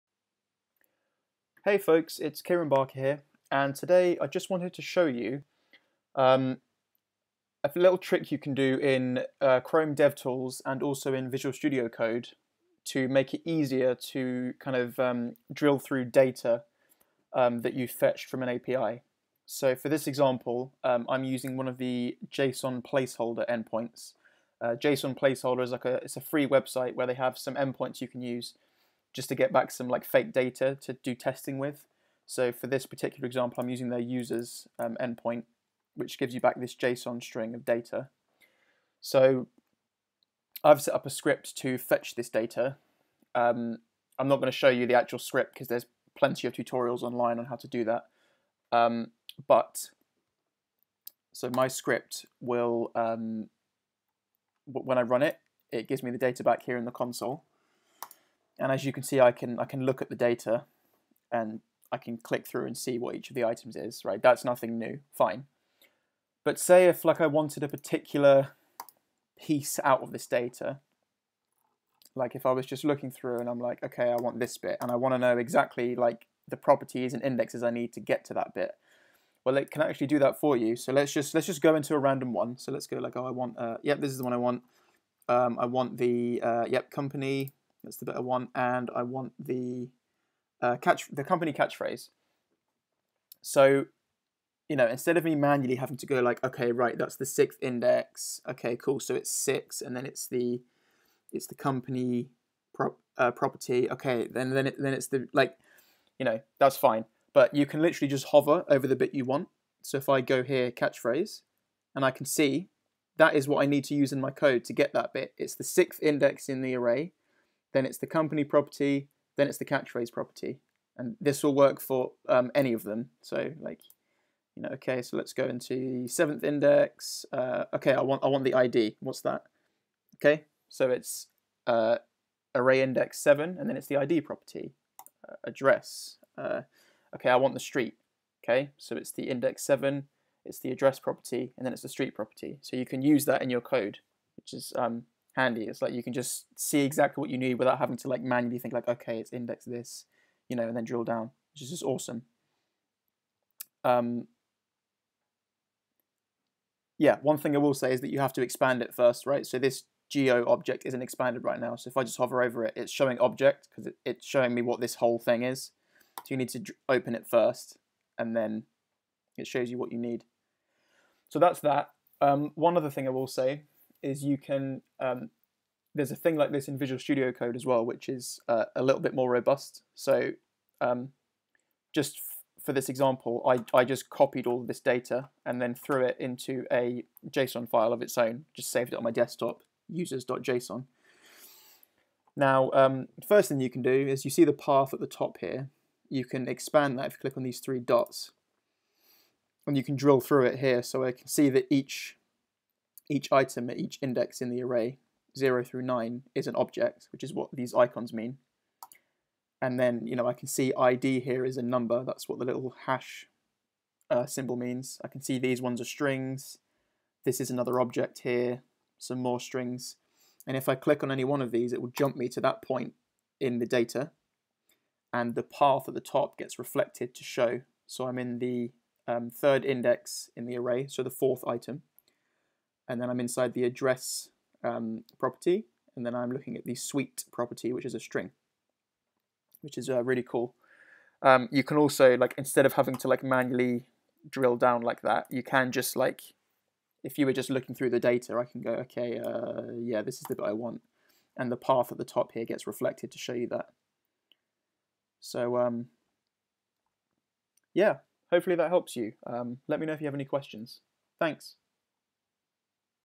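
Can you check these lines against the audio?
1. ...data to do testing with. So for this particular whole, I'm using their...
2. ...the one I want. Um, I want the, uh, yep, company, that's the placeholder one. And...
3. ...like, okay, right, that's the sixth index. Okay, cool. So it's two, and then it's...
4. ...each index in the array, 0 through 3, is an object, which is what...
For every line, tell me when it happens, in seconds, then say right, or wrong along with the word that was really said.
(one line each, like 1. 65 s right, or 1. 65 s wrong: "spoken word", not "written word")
1. 30 s wrong: "example", not "whole"
2. 84 s wrong: "better", not "placeholder"
3. 96 s wrong: "six", not "two"
4. 203 s wrong: "9", not "3".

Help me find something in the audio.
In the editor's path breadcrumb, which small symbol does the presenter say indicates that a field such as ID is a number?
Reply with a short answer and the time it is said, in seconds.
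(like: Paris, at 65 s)
hash, at 212 s.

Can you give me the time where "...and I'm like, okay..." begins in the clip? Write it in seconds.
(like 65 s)
73 s.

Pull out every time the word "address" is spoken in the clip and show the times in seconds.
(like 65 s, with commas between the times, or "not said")
135 s, 140 s, 233 s.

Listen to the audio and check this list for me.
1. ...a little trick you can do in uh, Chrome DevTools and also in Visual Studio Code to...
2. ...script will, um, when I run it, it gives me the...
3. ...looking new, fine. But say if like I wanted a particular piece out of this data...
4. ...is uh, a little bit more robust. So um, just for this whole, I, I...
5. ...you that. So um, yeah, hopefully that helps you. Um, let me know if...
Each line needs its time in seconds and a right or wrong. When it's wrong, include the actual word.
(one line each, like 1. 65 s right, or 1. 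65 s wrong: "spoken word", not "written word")
1. 7 s right
2. 51 s right
3. 64 s wrong: "nothing", not "looking"
4. 178 s wrong: "example", not "whole"
5. 253 s right.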